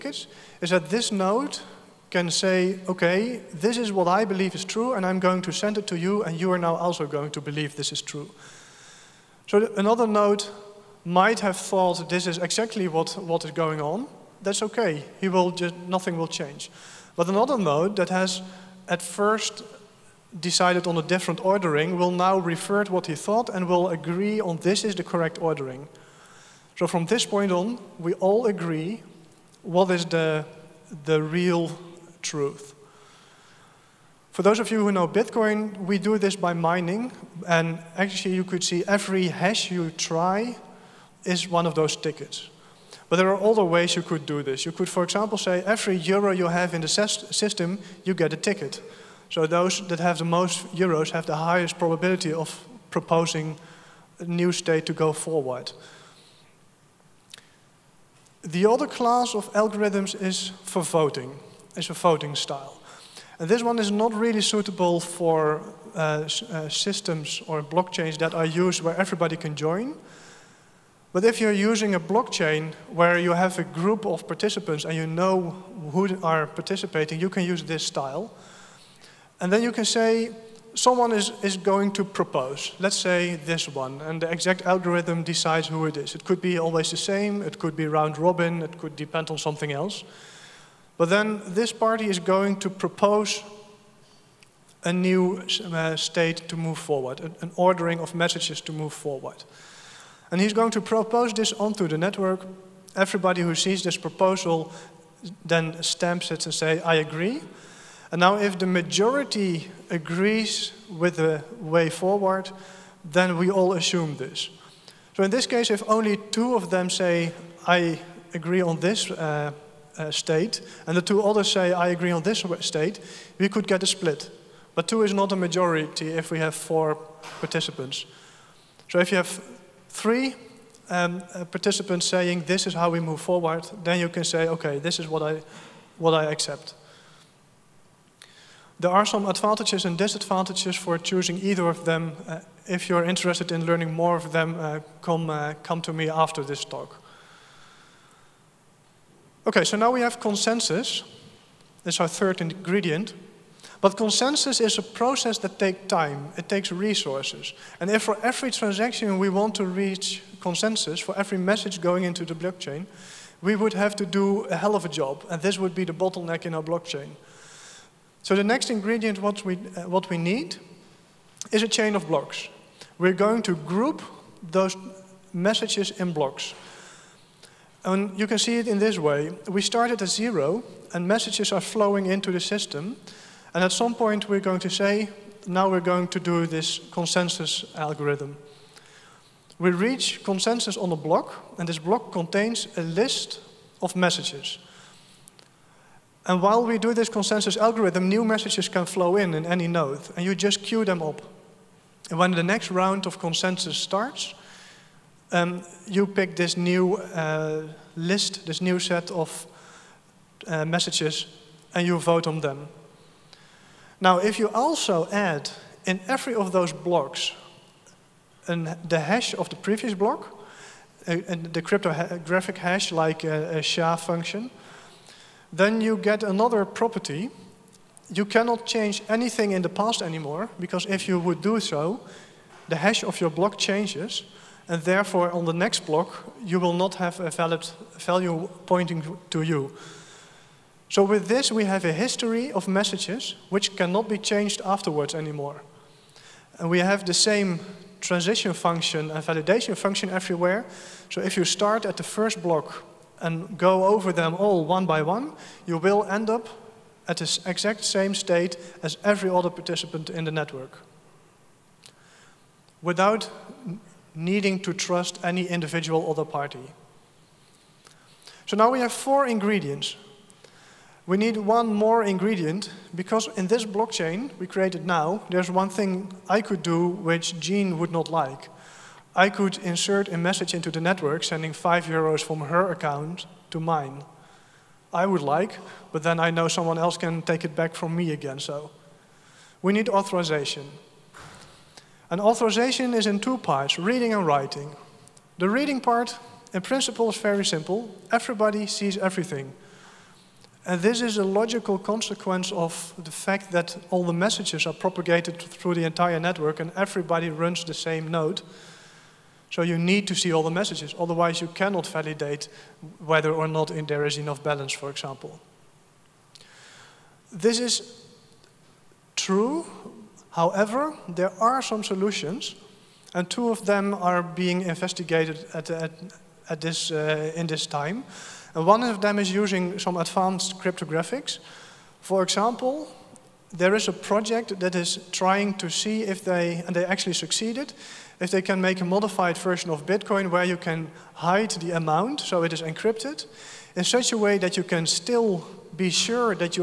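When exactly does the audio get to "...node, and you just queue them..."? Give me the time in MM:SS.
03:19.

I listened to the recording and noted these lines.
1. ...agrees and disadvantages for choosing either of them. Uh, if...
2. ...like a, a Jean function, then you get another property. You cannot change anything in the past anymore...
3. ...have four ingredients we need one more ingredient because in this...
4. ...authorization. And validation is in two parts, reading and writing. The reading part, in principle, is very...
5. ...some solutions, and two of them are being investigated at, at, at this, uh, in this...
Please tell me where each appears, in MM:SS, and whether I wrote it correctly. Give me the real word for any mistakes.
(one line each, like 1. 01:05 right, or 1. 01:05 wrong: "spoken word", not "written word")
1. 02:19 wrong: "advantages", not "agrees"
2. 03:42 wrong: "SHA", not "Jean"
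3. 04:28 right
4. 04:49 wrong: "authorization", not "validation"
5. 05:21 right.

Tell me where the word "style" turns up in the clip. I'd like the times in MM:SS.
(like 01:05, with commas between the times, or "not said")
01:02, 01:17.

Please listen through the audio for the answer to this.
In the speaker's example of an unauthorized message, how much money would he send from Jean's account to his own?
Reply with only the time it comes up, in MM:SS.
04:41.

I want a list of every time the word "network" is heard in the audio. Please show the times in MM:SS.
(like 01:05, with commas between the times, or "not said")
01:41, 04:20, 04:40, 05:06.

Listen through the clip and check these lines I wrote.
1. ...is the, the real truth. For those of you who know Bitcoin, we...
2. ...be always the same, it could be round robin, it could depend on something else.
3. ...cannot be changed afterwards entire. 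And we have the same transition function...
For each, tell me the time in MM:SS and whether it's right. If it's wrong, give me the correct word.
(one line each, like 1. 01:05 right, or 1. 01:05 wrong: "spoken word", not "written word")
1. 00:29 right
2. 01:26 right
3. 04:03 wrong: "anymore", not "entire".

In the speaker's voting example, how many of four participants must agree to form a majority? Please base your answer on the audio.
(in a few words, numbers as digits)
3.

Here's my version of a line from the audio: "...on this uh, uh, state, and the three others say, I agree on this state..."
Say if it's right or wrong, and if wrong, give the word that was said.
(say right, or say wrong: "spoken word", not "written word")
wrong: "two", not "three".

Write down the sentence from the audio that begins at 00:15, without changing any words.
He will just, nothing will change.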